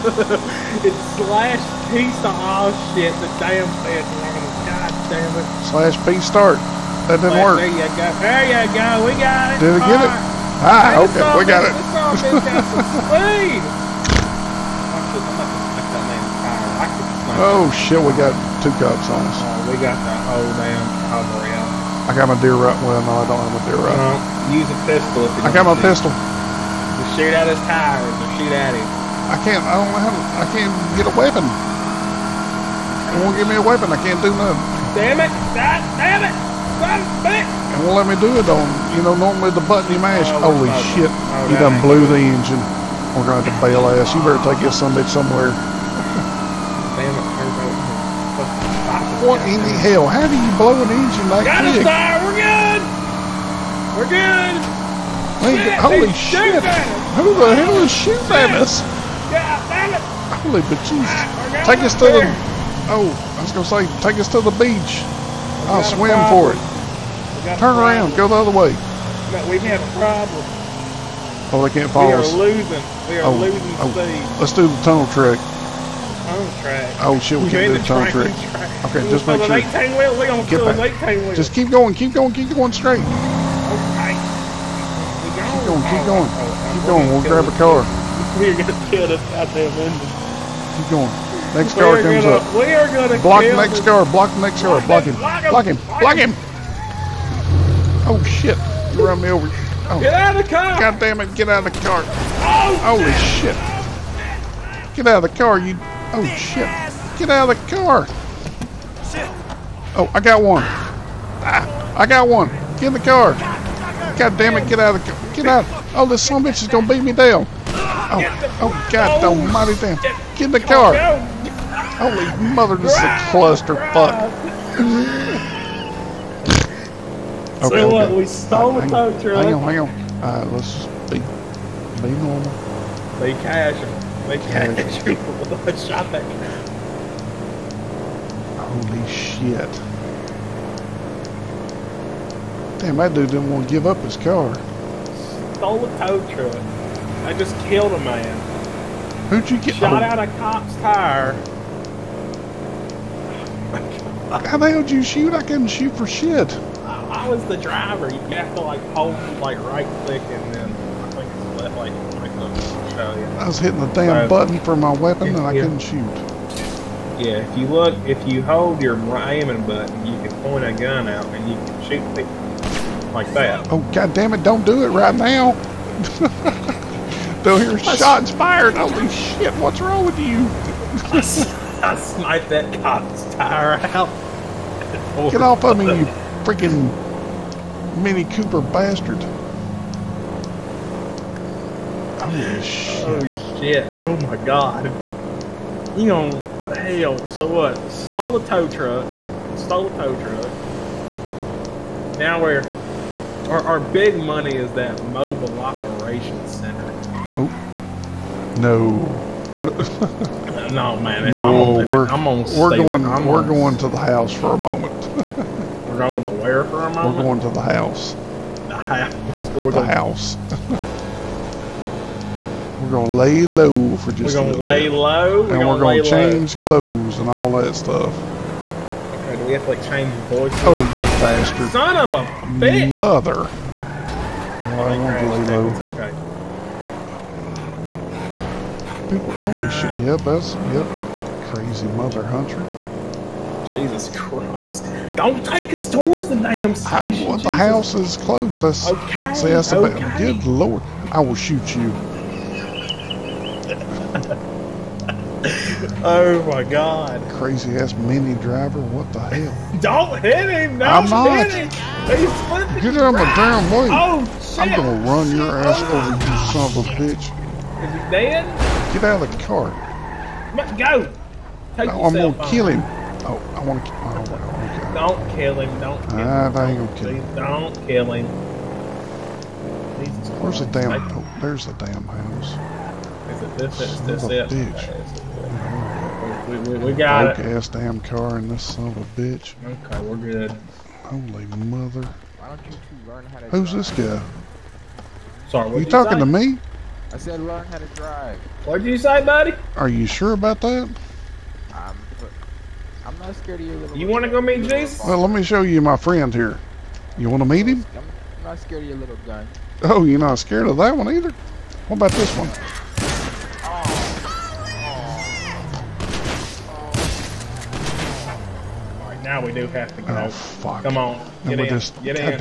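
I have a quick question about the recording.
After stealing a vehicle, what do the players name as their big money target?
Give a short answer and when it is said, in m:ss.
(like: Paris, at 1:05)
mobile operations center, at 3:25.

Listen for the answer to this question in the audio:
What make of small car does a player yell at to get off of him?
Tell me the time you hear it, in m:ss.
3:07.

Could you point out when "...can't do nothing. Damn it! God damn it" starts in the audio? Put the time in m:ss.
0:33.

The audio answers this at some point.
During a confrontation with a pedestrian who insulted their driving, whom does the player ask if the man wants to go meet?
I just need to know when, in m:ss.
5:04.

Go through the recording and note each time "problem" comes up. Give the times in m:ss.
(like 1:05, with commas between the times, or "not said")
1:09.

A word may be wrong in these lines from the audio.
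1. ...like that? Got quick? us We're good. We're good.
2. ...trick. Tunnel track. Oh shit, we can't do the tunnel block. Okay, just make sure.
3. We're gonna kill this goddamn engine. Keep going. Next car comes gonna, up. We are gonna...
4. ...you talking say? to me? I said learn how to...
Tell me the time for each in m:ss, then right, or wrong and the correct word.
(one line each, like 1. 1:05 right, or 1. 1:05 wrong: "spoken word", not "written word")
1. 0:51 right
2. 1:15 wrong: "trick", not "block"
3. 1:28 right
4. 4:55 right.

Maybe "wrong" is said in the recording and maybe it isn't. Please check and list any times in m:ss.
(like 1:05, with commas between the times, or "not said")
0:04, 2:59.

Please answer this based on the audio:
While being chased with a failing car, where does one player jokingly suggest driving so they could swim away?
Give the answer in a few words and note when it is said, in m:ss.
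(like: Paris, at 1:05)
the beach, at 1:04.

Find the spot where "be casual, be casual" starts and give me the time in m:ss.
2:13.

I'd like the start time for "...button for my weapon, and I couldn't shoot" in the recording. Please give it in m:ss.
2:44.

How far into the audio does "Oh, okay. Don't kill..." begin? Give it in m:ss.
4:33.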